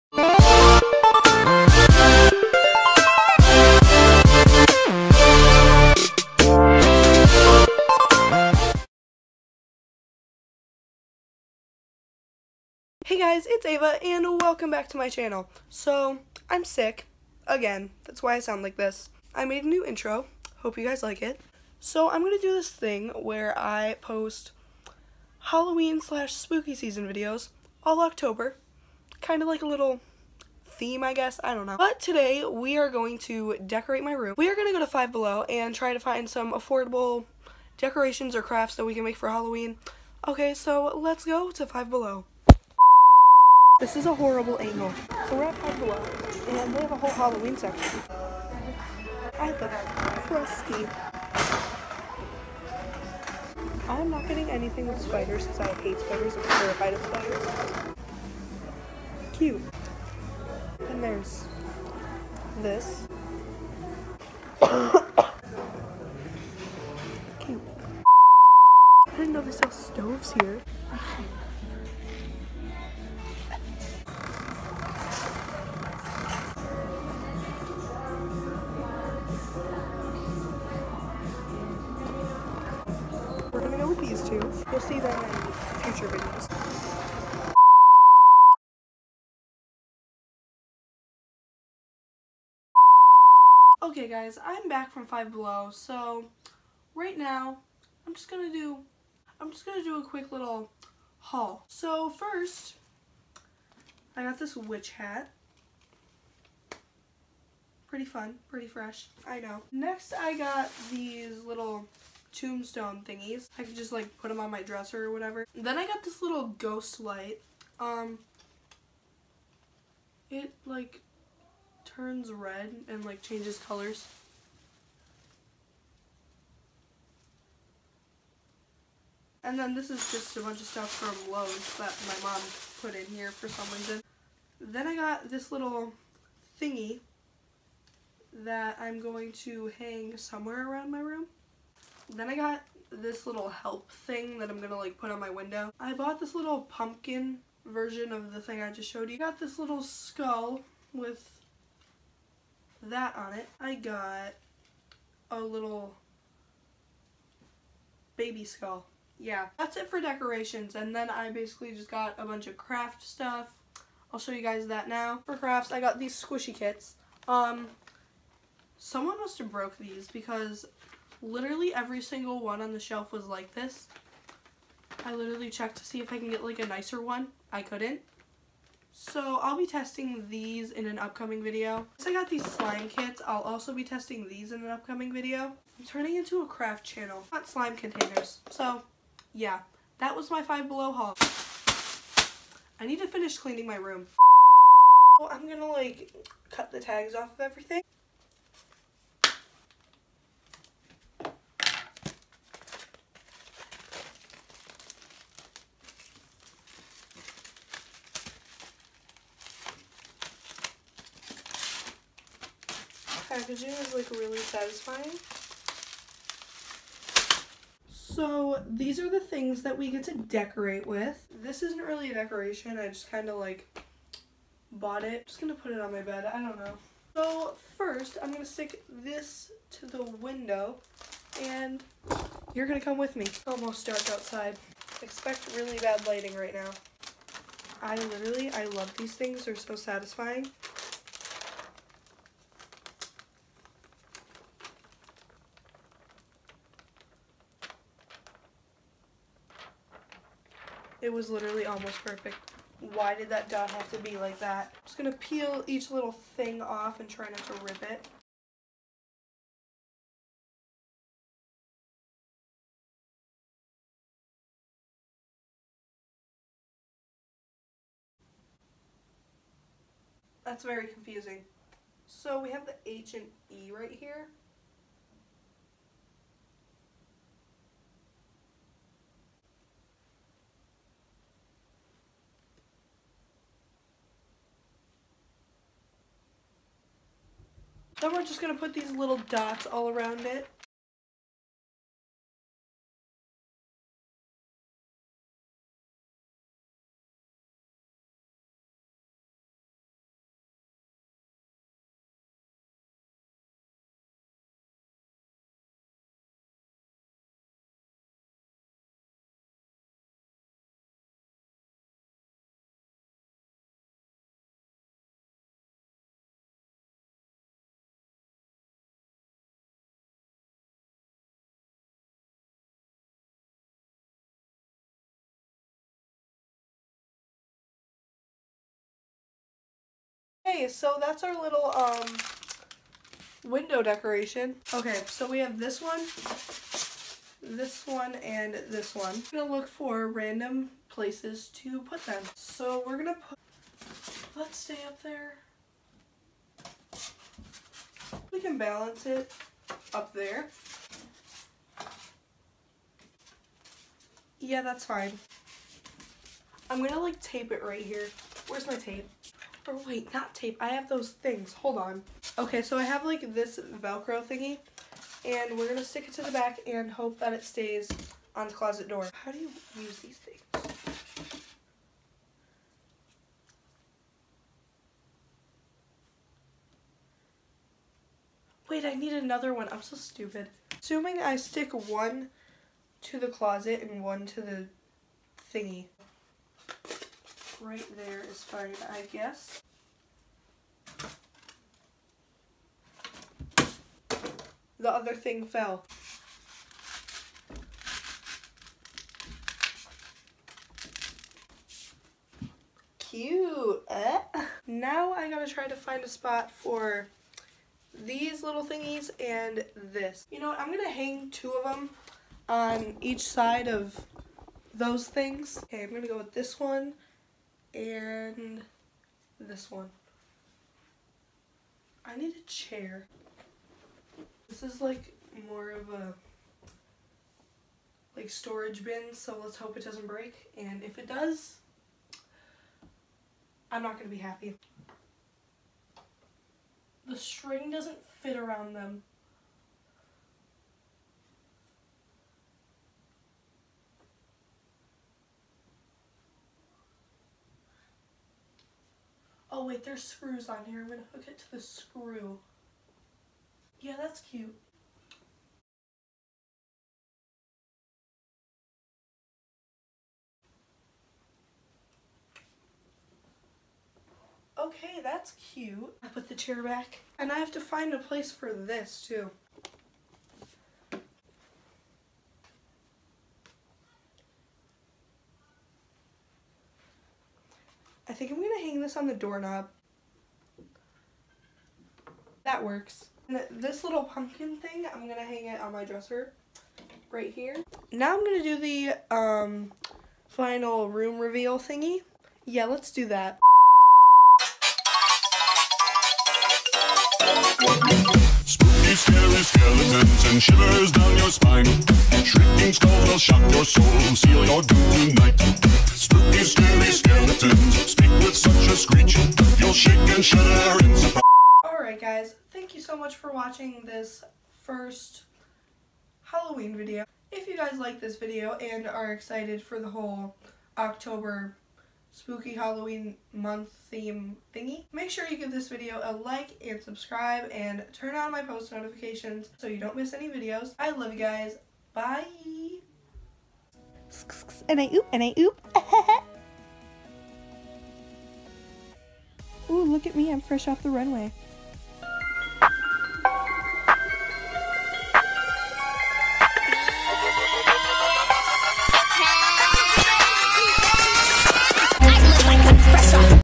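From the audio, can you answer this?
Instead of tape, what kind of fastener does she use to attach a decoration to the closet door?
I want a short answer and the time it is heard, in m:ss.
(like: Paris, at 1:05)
Velcro, at 6:03.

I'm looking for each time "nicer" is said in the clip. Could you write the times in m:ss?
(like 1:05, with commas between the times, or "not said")
2:56.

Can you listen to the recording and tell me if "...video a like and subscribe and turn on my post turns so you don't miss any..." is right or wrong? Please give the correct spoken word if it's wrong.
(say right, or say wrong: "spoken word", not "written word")
wrong: "notifications", not "turns".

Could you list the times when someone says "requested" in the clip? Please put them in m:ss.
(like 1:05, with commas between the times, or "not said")
not said.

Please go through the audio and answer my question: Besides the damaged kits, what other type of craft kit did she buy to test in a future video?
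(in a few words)
slime kits.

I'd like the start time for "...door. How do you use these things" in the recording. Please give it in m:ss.
6:08.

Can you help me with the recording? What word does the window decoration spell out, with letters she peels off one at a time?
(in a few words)
help.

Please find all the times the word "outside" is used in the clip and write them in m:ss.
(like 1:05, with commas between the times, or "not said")
3:54.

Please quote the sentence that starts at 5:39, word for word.
I'm gonna look for random places to put them.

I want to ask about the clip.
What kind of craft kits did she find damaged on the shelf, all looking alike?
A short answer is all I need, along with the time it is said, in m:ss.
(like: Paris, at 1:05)
squishy kits, at 2:46.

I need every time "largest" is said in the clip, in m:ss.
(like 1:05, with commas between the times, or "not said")
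not said.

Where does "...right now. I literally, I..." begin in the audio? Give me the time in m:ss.
3:56.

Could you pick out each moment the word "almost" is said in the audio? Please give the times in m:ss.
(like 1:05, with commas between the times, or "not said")
3:53, 4:11.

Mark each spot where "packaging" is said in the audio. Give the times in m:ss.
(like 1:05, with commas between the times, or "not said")
3:33.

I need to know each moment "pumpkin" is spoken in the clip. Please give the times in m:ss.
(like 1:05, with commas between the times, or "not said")
2:26, 8:04.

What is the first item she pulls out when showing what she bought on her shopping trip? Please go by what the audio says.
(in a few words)
witch hat.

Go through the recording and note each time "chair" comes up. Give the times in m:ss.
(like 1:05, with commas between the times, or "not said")
7:02, 7:46.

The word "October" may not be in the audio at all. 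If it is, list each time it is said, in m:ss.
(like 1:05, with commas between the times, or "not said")
0:28, 8:40.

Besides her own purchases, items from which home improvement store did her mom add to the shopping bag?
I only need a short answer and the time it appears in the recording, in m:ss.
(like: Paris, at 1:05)
Lowe's, at 2:11.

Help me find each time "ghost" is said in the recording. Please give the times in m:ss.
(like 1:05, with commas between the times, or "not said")
1:56.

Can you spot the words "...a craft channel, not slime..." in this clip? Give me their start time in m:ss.
3:06.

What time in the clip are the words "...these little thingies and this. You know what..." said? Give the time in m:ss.
6:47.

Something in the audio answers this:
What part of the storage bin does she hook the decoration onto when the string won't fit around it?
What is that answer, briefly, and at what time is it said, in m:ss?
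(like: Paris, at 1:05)
the screw, at 7:31.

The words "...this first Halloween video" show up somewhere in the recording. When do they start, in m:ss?
8:33.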